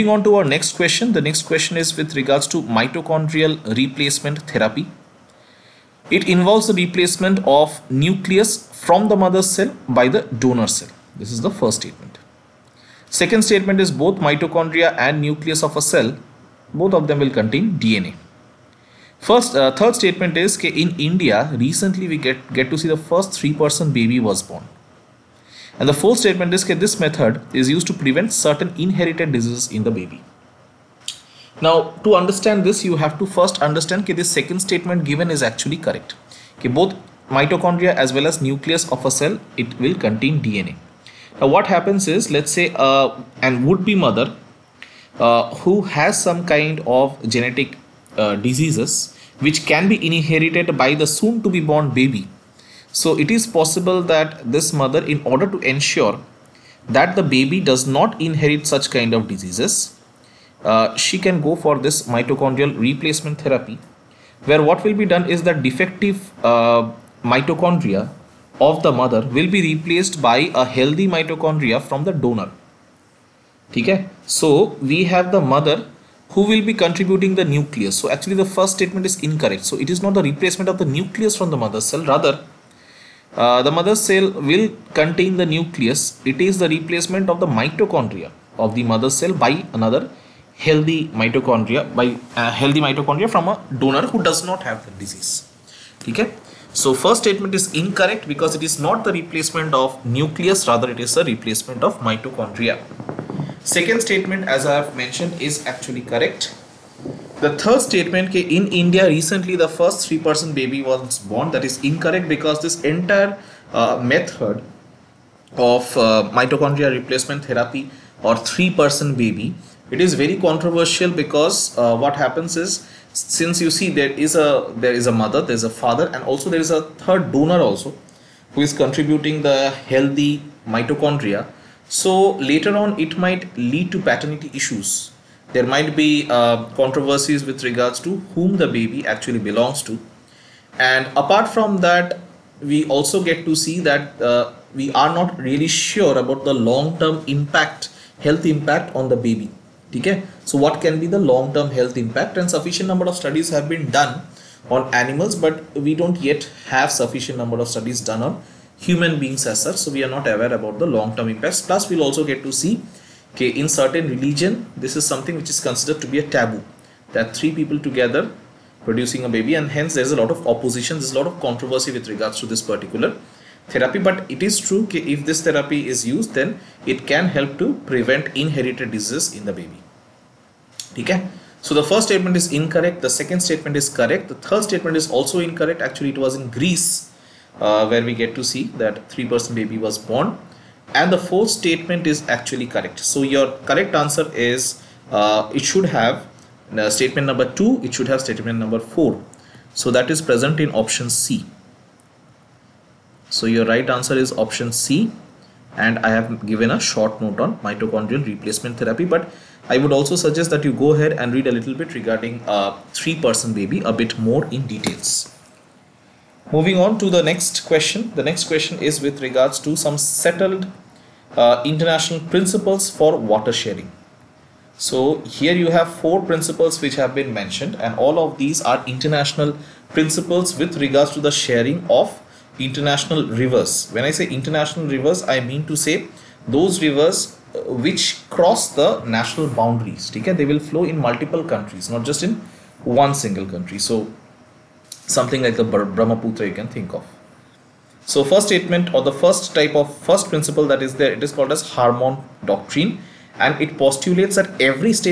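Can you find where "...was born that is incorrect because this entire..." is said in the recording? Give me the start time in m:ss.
1:50.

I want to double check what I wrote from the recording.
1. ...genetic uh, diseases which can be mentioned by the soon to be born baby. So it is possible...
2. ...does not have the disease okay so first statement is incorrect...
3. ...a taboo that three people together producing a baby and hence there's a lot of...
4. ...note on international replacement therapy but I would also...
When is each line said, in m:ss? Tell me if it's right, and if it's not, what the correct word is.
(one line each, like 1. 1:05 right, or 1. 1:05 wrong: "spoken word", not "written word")
1. 0:47 wrong: "inherited", not "mentioned"
2. 1:34 right
3. 2:46 right
4. 3:27 wrong: "mitochondrial", not "international".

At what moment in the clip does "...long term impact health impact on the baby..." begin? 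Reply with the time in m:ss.
2:26.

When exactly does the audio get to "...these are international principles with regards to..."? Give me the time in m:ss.
3:48.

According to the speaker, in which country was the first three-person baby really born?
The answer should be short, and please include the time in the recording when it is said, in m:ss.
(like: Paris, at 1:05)
Greece, at 3:06.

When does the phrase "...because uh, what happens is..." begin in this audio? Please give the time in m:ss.
2:01.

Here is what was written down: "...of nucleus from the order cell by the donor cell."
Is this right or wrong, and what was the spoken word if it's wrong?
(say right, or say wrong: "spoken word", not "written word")
wrong: "mother", not "order".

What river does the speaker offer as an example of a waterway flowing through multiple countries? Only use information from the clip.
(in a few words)
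Brahmaputra.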